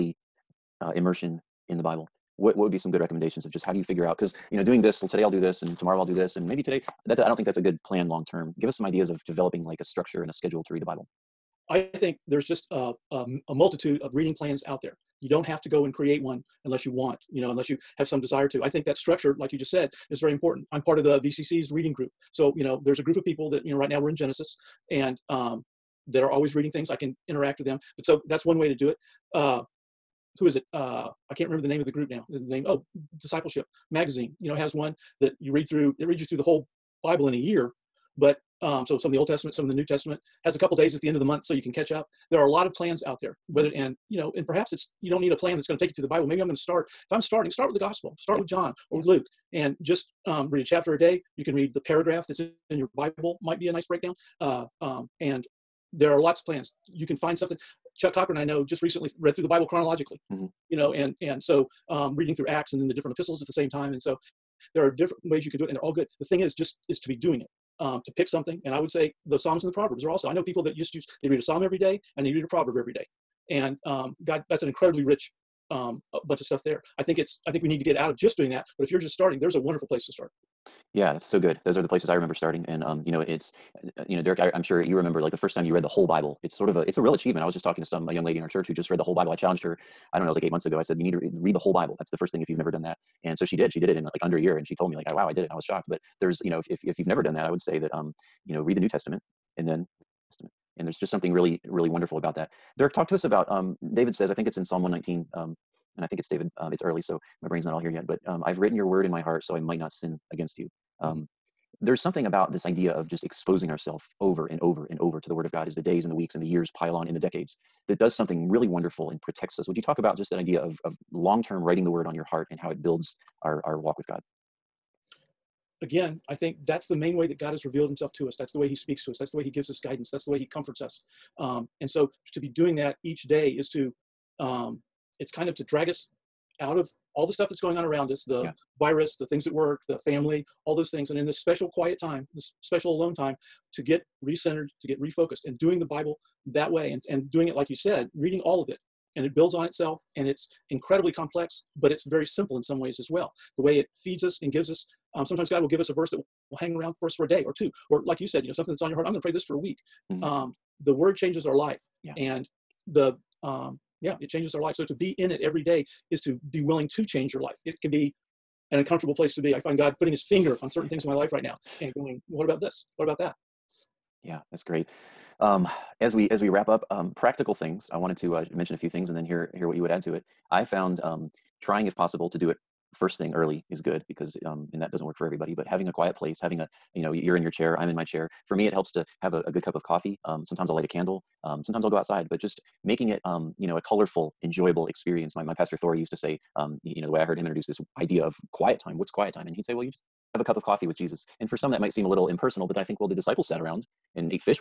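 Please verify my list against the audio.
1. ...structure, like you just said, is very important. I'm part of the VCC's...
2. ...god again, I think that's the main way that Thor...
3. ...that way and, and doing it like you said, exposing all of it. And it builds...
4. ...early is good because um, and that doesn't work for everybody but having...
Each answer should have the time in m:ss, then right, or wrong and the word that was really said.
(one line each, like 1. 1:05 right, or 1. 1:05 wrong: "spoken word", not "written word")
1. 0:18 right
2. 2:04 wrong: "God", not "Thor"
3. 2:26 wrong: "reading", not "exposing"
4. 3:03 right.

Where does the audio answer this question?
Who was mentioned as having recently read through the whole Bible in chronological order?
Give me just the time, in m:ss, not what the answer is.
0:57.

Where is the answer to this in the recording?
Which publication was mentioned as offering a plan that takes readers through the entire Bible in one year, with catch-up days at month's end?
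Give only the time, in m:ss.
0:33.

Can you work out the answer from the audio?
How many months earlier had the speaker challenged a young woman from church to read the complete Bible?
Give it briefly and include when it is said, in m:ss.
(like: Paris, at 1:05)
8, at 1:30.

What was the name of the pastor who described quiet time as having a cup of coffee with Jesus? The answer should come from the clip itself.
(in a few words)
Thor.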